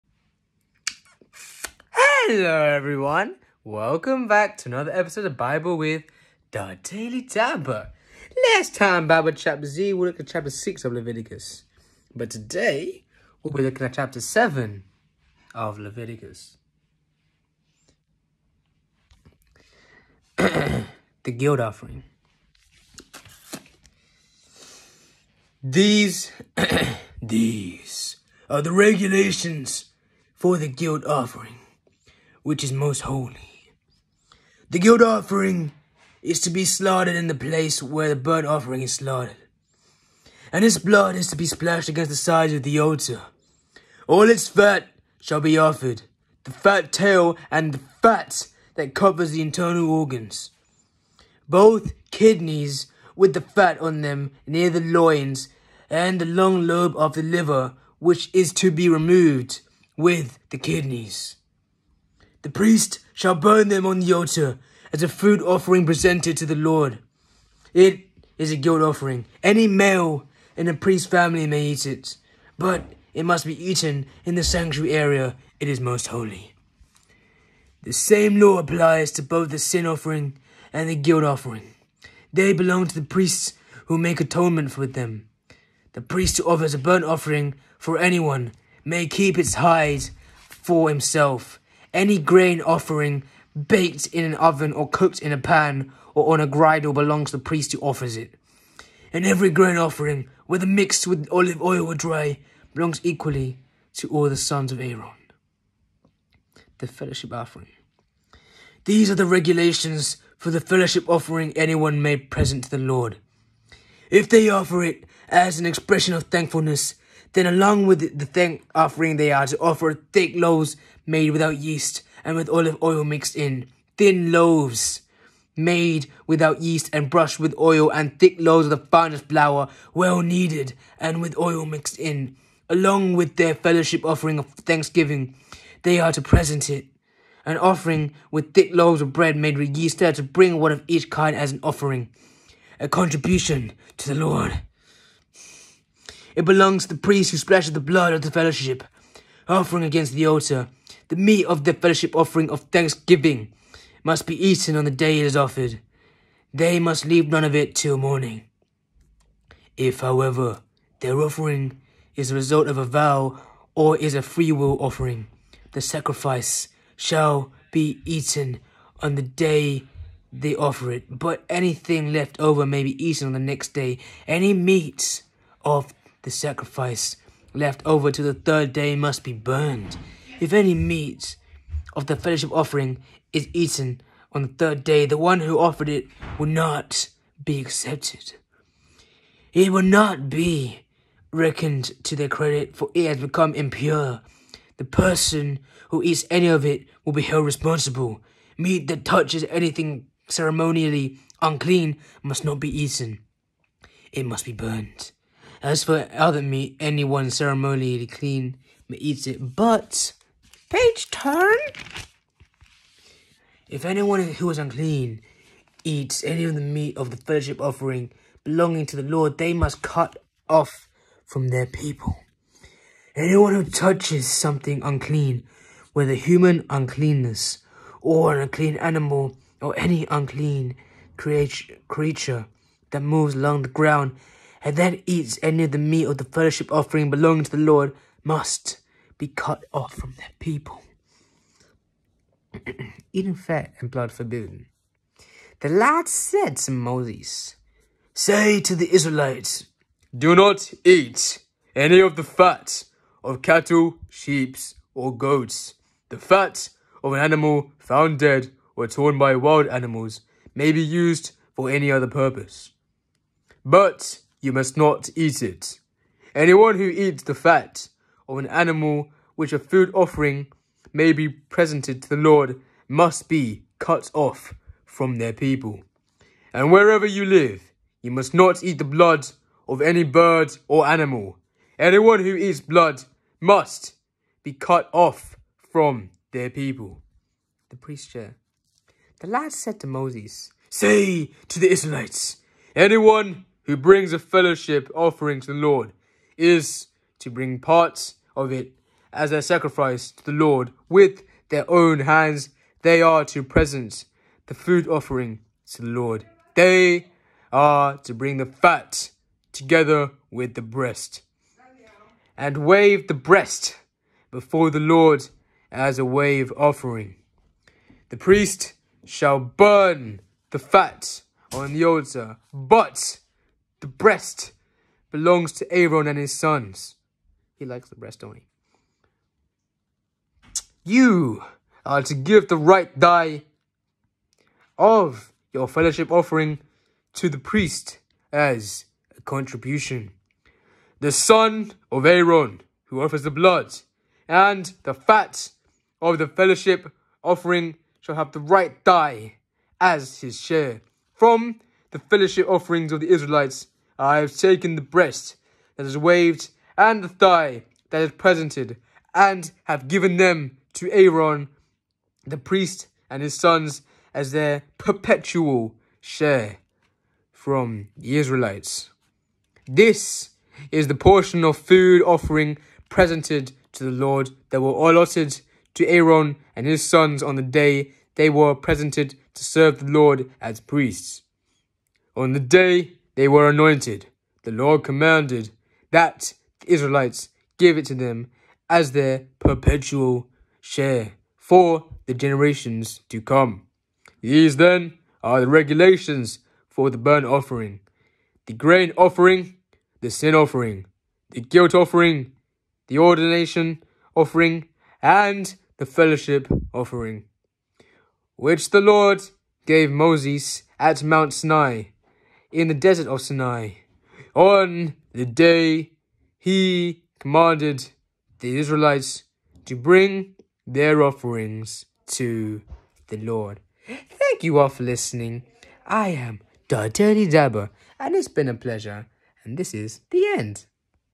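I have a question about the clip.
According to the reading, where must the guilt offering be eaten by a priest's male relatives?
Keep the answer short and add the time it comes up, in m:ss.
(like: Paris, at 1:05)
sanctuary area, at 1:14.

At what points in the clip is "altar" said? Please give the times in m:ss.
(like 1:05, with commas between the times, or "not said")
0:42, 1:04, 2:30, 5:21.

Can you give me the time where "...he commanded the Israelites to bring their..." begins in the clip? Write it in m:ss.
6:56.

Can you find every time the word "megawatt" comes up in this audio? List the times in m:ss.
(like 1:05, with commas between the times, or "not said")
not said.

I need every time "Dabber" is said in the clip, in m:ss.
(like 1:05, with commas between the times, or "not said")
0:07, 7:07.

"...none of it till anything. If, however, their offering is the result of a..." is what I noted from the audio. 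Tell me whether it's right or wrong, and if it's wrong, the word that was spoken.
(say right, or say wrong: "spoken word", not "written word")
wrong: "morning", not "anything".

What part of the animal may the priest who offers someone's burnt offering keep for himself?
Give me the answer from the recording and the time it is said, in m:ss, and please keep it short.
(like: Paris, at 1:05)
its hide, at 1:29.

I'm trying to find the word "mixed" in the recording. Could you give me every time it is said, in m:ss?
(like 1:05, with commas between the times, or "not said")
1:40, 2:03, 2:11.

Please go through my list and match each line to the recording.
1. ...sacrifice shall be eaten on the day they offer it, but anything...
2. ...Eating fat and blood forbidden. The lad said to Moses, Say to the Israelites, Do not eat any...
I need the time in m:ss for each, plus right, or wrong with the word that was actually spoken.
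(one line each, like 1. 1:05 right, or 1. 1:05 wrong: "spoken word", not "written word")
1. 2:45 right
2. 4:03 right.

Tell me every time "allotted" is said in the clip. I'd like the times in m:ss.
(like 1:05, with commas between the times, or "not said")
6:14.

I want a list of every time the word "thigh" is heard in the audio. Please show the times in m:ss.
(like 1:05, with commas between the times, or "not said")
5:32, 5:48, 5:57.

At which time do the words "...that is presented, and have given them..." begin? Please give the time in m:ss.
5:57.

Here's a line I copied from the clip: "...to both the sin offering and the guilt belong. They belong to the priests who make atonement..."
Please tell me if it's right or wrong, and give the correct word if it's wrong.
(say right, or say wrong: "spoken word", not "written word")
wrong: "offering", not "belong".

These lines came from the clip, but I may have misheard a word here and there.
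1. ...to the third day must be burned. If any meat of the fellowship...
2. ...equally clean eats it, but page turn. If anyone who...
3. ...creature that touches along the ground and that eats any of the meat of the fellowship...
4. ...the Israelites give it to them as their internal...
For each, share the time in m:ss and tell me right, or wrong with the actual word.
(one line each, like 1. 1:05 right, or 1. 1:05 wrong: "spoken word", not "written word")
1. 2:58 right
2. 3:27 wrong: "ceremonially", not "equally"
3. 3:51 wrong: "moves", not "touches"
4. 6:26 wrong: "perpetual", not "internal".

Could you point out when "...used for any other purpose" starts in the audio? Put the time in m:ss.
4:20.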